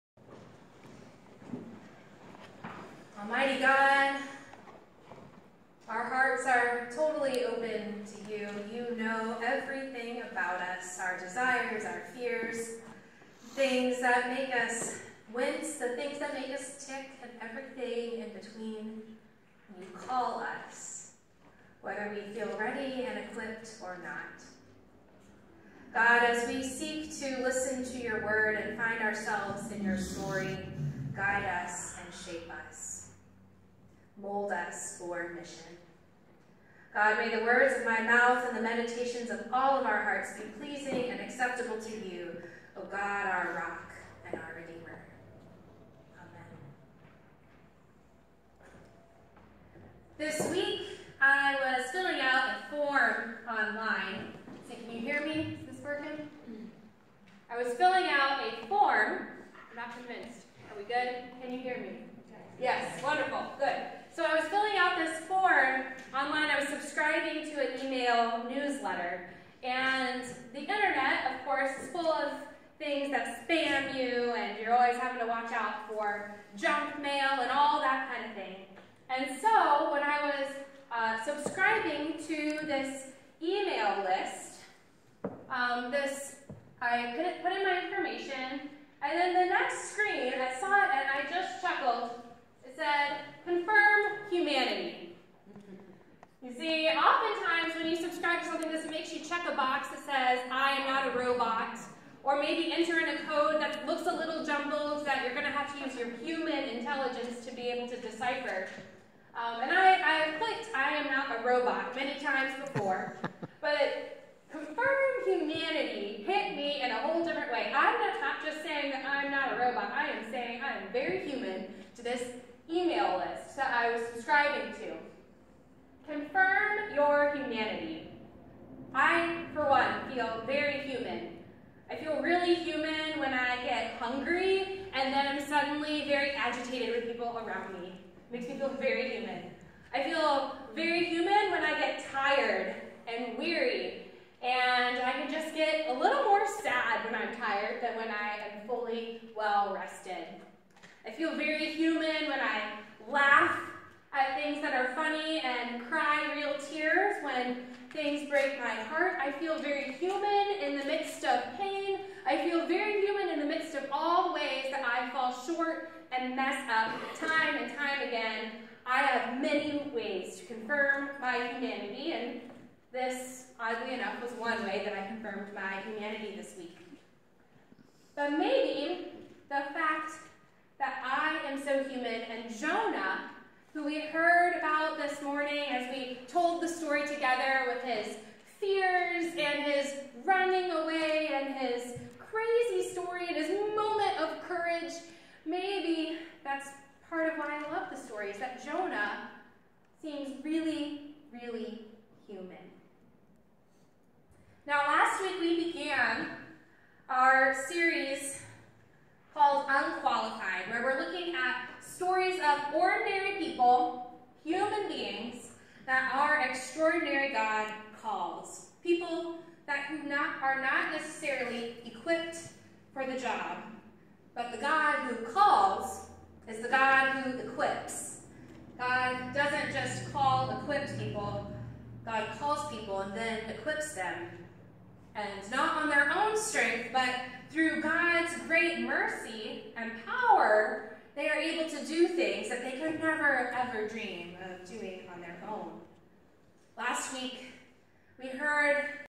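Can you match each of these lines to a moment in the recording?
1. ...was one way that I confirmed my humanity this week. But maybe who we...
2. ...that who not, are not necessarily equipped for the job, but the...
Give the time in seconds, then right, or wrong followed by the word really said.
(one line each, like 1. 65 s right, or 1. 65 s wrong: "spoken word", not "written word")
1. 174 s right
2. 219 s right.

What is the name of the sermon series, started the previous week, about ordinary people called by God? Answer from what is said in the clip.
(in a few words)
Unqualified.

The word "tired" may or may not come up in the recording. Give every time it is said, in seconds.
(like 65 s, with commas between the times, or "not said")
142 s, 147 s.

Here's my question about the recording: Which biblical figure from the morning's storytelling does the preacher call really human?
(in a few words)
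Jonah.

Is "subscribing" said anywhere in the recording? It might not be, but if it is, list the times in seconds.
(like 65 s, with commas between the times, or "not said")
81 s, 124 s.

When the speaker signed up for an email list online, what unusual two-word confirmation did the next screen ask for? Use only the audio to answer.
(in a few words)
Confirm humanity.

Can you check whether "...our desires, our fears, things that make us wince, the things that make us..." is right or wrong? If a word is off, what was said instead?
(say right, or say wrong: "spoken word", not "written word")
right.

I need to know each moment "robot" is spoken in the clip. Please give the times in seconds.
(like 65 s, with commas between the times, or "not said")
101 s, 111 s, 119 s.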